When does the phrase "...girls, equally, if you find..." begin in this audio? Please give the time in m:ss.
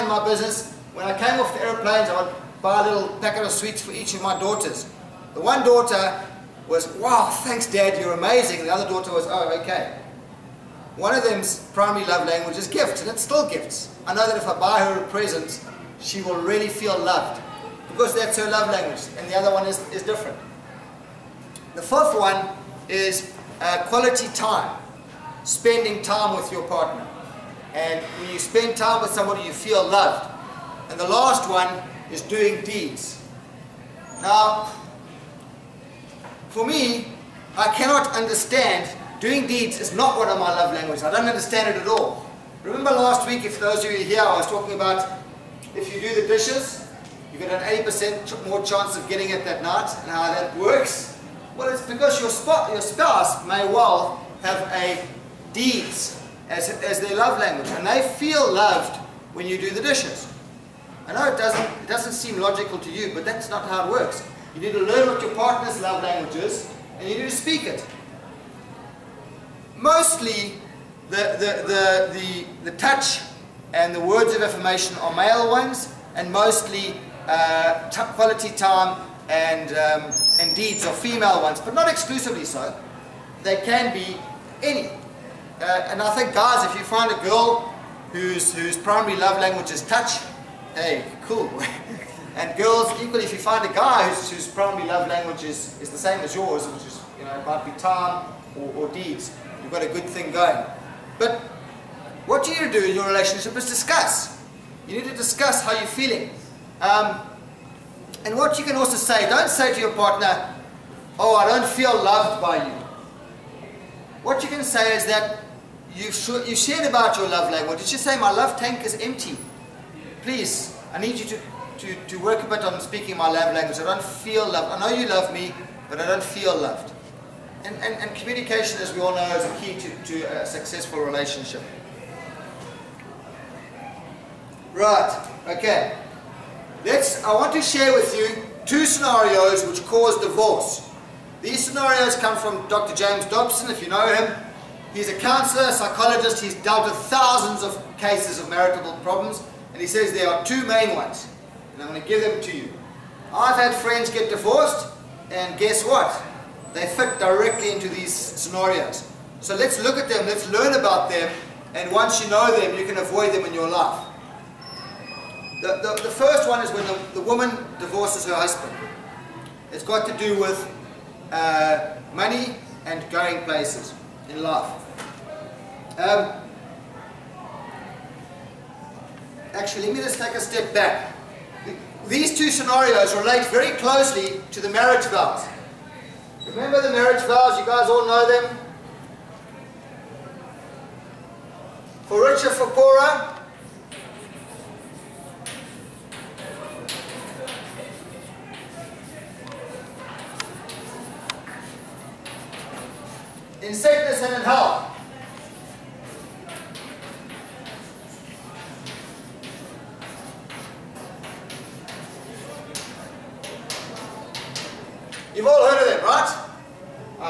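1:32.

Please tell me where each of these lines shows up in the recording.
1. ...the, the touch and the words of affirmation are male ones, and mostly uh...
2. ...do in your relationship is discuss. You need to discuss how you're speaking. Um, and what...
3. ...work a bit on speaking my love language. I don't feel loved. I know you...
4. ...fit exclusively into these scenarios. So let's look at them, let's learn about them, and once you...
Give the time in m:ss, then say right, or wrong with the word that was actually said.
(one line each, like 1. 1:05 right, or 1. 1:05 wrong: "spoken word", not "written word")
1. 1:12 right
2. 1:42 wrong: "feeling", not "speaking"
3. 2:02 right
4. 2:36 wrong: "directly", not "exclusively".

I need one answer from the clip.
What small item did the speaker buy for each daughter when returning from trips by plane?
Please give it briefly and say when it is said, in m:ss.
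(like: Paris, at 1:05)
packet of sweets, at 0:03.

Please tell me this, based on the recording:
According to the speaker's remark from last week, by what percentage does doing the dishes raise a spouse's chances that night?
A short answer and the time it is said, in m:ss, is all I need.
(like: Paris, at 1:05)
80%, at 0:47.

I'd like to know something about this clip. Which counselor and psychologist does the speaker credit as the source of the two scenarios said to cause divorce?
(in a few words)
Dr. James Dobson.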